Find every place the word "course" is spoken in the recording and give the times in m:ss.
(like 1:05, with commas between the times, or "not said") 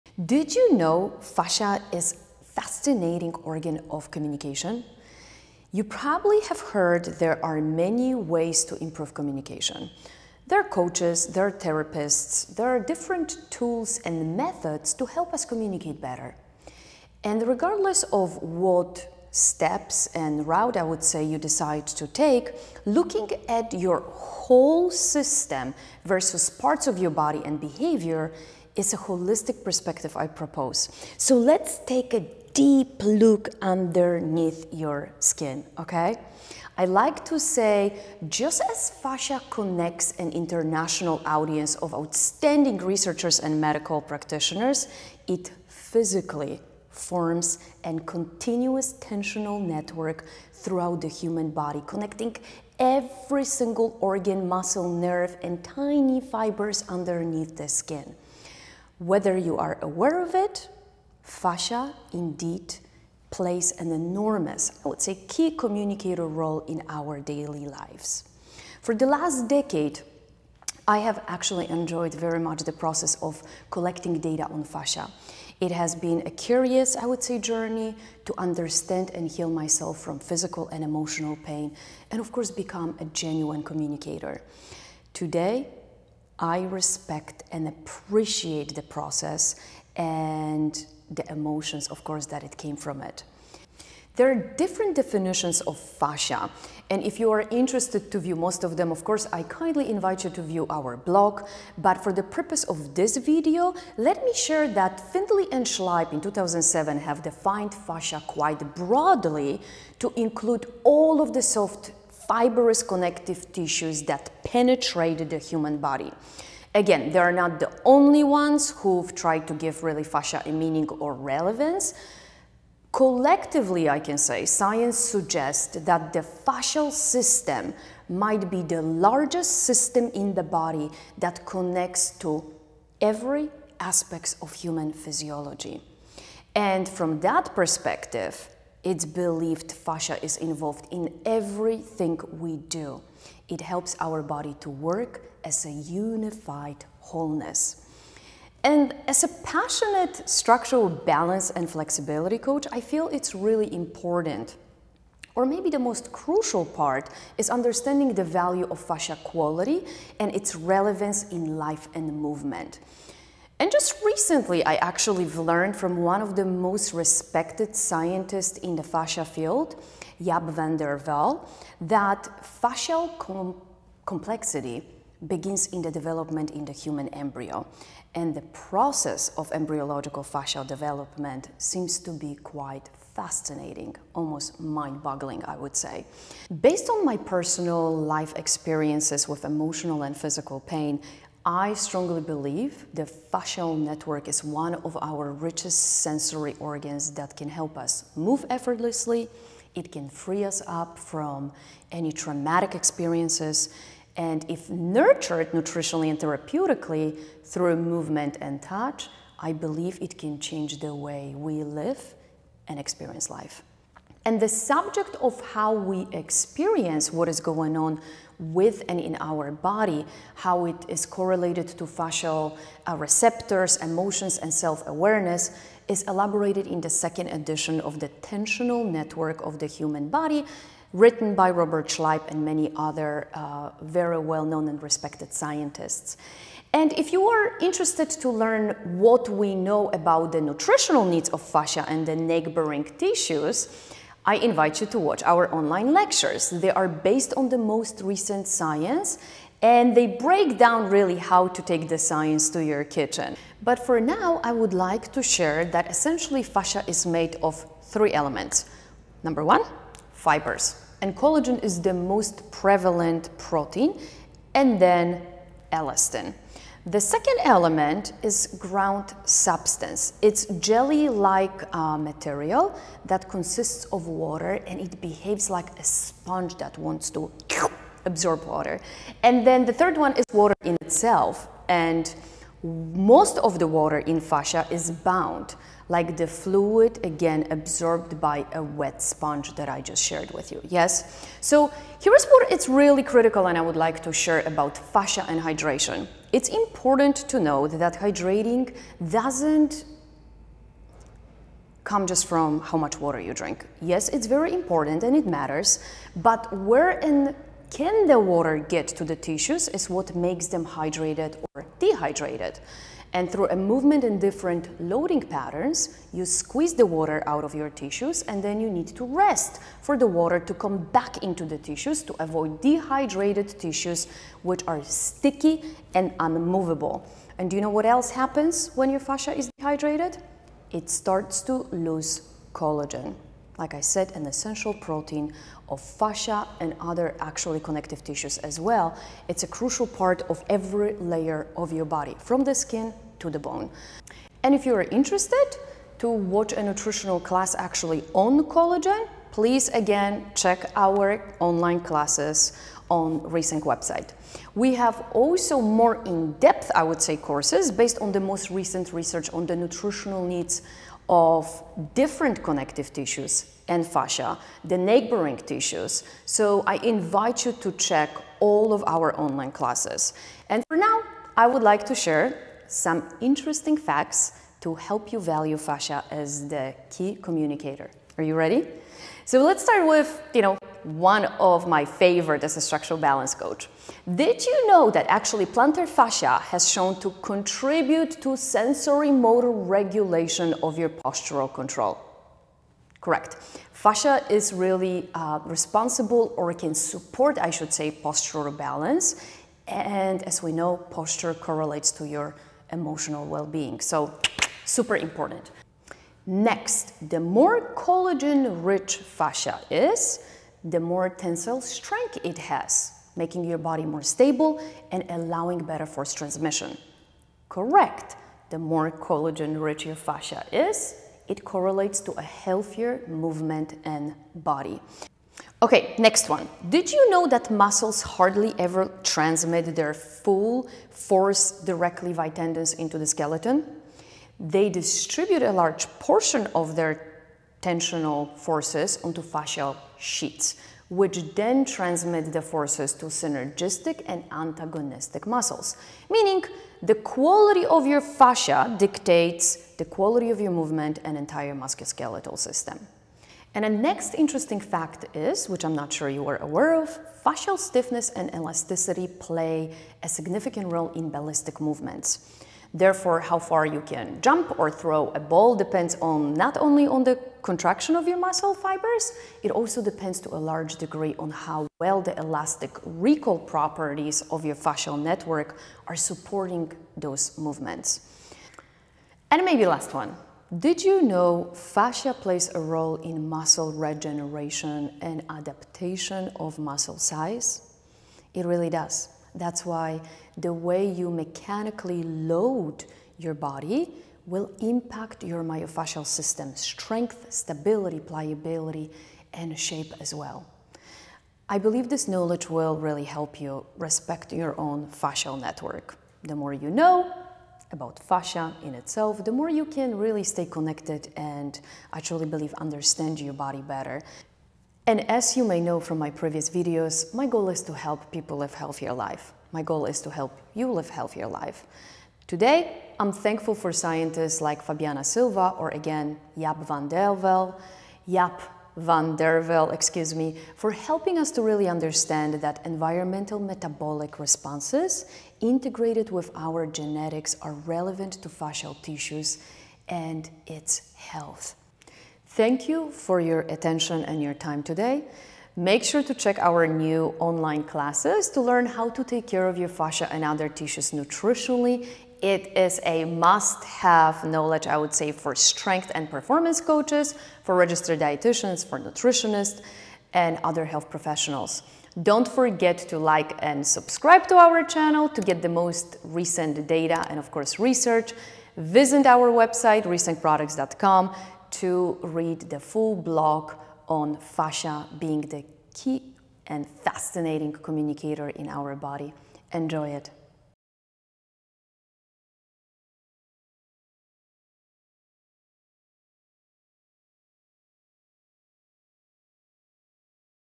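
1:22, 1:32, 1:39, 5:57, 9:27.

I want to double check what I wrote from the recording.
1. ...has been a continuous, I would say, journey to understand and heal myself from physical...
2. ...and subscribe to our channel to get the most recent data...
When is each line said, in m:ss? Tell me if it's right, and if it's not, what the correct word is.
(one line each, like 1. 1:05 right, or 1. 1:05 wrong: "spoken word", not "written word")
1. 1:15 wrong: "curious", not "continuous"
2. 9:23 right.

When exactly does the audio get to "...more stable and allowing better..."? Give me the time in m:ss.
6:53.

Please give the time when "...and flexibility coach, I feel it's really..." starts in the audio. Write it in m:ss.
2:31.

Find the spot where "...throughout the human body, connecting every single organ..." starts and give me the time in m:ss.
0:50.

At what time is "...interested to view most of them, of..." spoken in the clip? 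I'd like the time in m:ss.
1:37.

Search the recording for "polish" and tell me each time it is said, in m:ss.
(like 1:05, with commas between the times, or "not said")
not said.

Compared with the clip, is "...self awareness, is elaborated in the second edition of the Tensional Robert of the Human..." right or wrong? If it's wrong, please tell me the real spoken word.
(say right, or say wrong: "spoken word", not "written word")
wrong: "Network", not "Robert".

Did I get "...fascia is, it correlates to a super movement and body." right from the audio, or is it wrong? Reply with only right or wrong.
wrong.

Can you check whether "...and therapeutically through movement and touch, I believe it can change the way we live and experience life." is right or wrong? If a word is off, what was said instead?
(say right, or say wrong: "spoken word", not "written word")
right.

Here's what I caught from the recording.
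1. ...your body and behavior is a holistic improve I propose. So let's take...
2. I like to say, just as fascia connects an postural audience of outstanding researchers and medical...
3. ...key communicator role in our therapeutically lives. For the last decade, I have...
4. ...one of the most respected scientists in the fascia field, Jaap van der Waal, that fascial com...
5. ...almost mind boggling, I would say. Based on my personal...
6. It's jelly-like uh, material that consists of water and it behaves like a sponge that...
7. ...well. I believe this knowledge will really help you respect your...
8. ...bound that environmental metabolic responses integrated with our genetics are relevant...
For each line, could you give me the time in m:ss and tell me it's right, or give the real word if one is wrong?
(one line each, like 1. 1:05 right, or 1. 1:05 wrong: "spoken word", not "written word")
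1. 0:26 wrong: "perspective", not "improve"
2. 0:36 wrong: "international", not "postural"
3. 1:05 wrong: "daily", not "therapeutically"
4. 2:45 right
5. 3:04 right
6. 4:30 right
7. 8:20 right
8. 8:51 wrong: "understand", not "bound".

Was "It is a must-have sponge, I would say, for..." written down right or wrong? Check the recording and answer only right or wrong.
wrong.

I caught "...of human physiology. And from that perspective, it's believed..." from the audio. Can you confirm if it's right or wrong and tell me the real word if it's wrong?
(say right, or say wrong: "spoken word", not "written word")
right.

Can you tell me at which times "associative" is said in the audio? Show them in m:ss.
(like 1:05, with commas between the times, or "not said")
not said.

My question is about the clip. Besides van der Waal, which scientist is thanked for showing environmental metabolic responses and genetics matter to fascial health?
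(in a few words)
Fabiana Silva.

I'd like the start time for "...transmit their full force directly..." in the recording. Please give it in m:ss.
7:09.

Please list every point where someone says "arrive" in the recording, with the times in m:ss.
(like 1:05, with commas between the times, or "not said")
not said.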